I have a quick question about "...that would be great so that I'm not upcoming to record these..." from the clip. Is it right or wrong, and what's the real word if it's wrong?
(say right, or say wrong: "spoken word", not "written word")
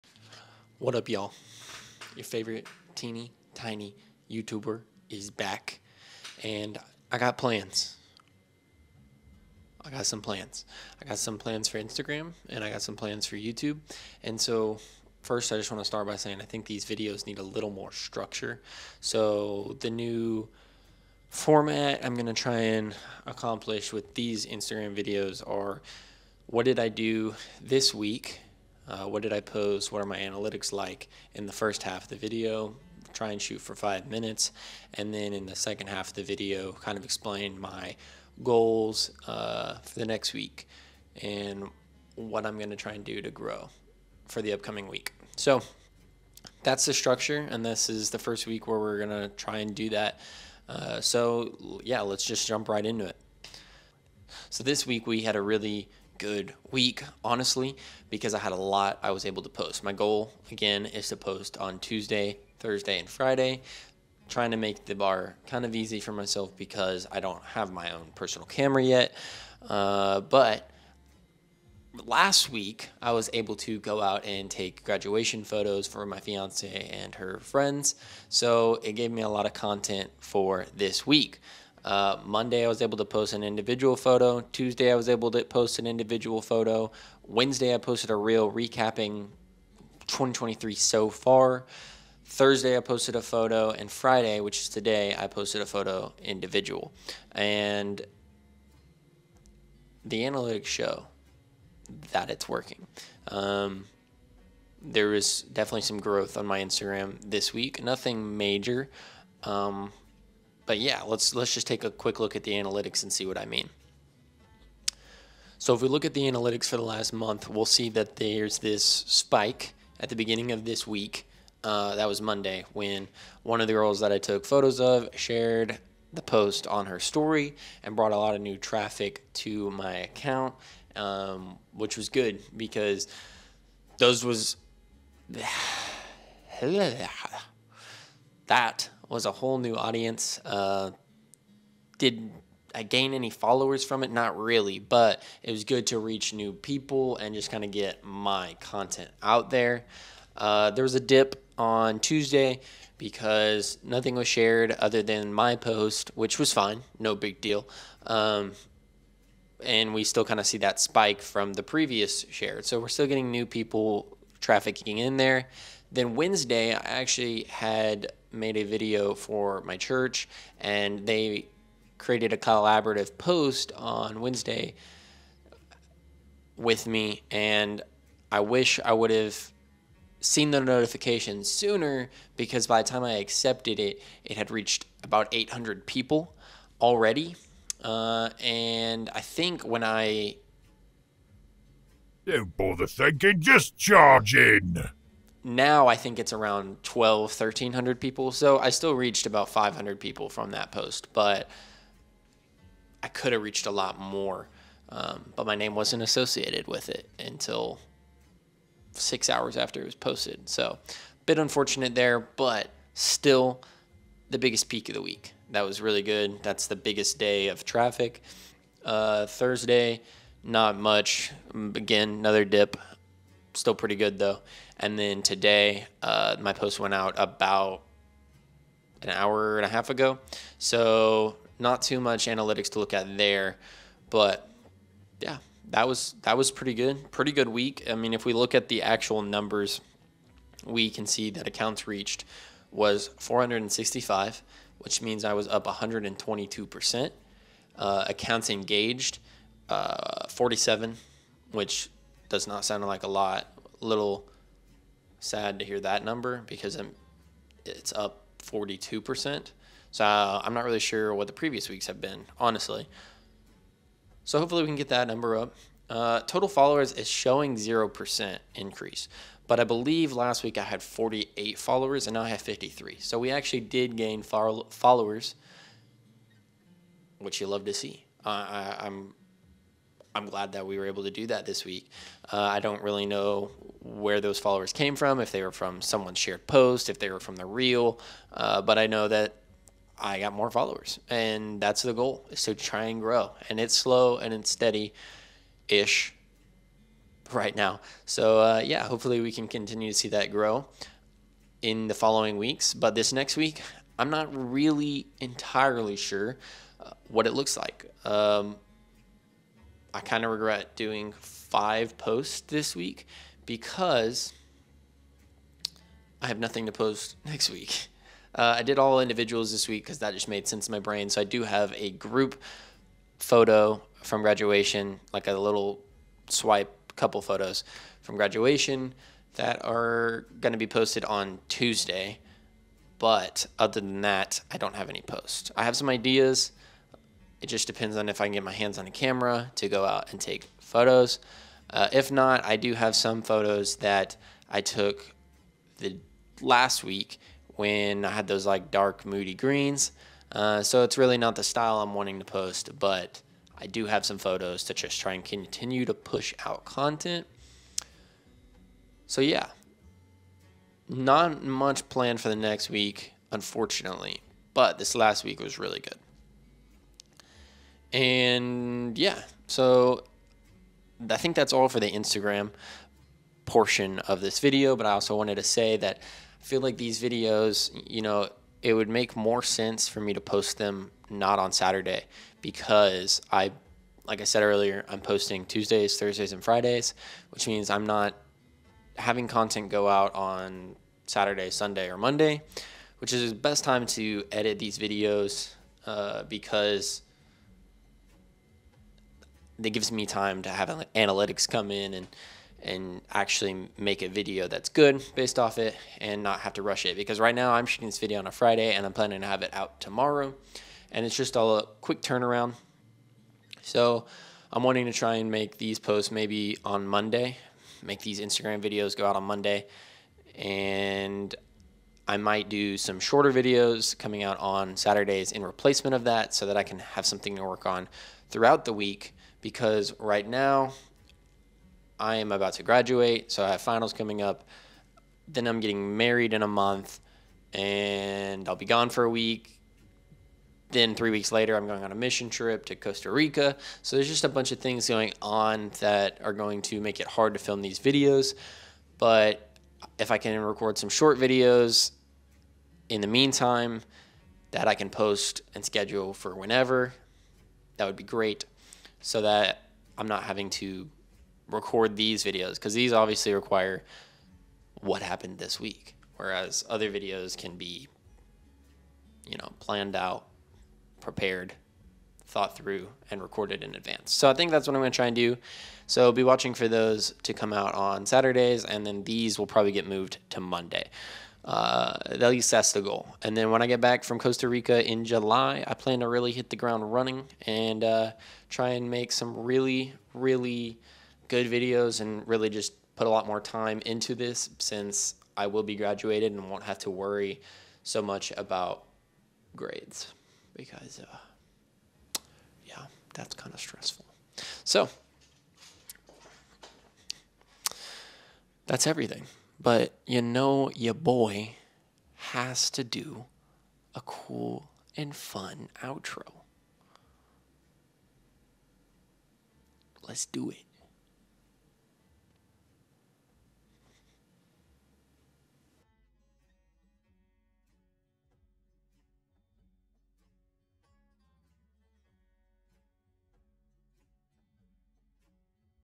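wrong: "having", not "upcoming".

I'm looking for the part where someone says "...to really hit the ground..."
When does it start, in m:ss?
8:06.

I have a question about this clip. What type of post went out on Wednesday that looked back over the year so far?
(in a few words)
A reel.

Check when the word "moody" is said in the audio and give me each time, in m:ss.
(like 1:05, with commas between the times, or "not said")
5:49.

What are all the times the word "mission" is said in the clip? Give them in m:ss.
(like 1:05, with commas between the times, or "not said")
7:21.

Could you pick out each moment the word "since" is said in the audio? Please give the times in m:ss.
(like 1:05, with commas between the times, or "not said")
8:14.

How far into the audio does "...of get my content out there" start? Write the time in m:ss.
2:27.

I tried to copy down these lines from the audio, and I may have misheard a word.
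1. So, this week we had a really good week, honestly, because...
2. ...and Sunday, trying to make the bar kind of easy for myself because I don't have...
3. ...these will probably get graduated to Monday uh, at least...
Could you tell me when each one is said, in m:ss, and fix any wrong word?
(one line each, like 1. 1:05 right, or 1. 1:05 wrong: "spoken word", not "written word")
1. 0:54 right
2. 1:02 wrong: "Friday", not "Sunday"
3. 7:59 wrong: "moved", not "graduated".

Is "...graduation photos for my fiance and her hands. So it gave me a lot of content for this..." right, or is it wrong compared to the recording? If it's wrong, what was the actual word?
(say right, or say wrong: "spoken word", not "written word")
wrong: "friends", not "hands".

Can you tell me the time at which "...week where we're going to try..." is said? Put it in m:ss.
0:48.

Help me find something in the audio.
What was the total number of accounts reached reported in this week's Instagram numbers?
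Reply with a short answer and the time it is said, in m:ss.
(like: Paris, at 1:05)
465, at 4:03.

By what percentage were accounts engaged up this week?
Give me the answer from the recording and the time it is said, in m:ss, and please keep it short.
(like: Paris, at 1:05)
42%, at 4:18.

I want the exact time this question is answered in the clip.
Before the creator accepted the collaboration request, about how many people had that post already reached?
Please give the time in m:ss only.
3:05.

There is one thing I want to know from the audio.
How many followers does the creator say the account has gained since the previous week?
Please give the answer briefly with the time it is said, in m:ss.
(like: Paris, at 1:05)
53, at 4:32.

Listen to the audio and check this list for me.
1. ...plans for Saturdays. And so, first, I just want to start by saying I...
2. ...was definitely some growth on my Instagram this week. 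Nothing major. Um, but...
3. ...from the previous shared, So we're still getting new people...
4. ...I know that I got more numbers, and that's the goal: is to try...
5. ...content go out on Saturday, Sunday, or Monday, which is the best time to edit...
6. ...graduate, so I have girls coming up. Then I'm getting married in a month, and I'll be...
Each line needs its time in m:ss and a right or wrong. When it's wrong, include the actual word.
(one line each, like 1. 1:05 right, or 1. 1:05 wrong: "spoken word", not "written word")
1. 0:12 wrong: "YouTube", not "Saturdays"
2. 1:45 right
3. 2:41 right
4. 4:48 wrong: "followers", not "numbers"
5. 6:29 right
6. 7:12 wrong: "finals", not "girls".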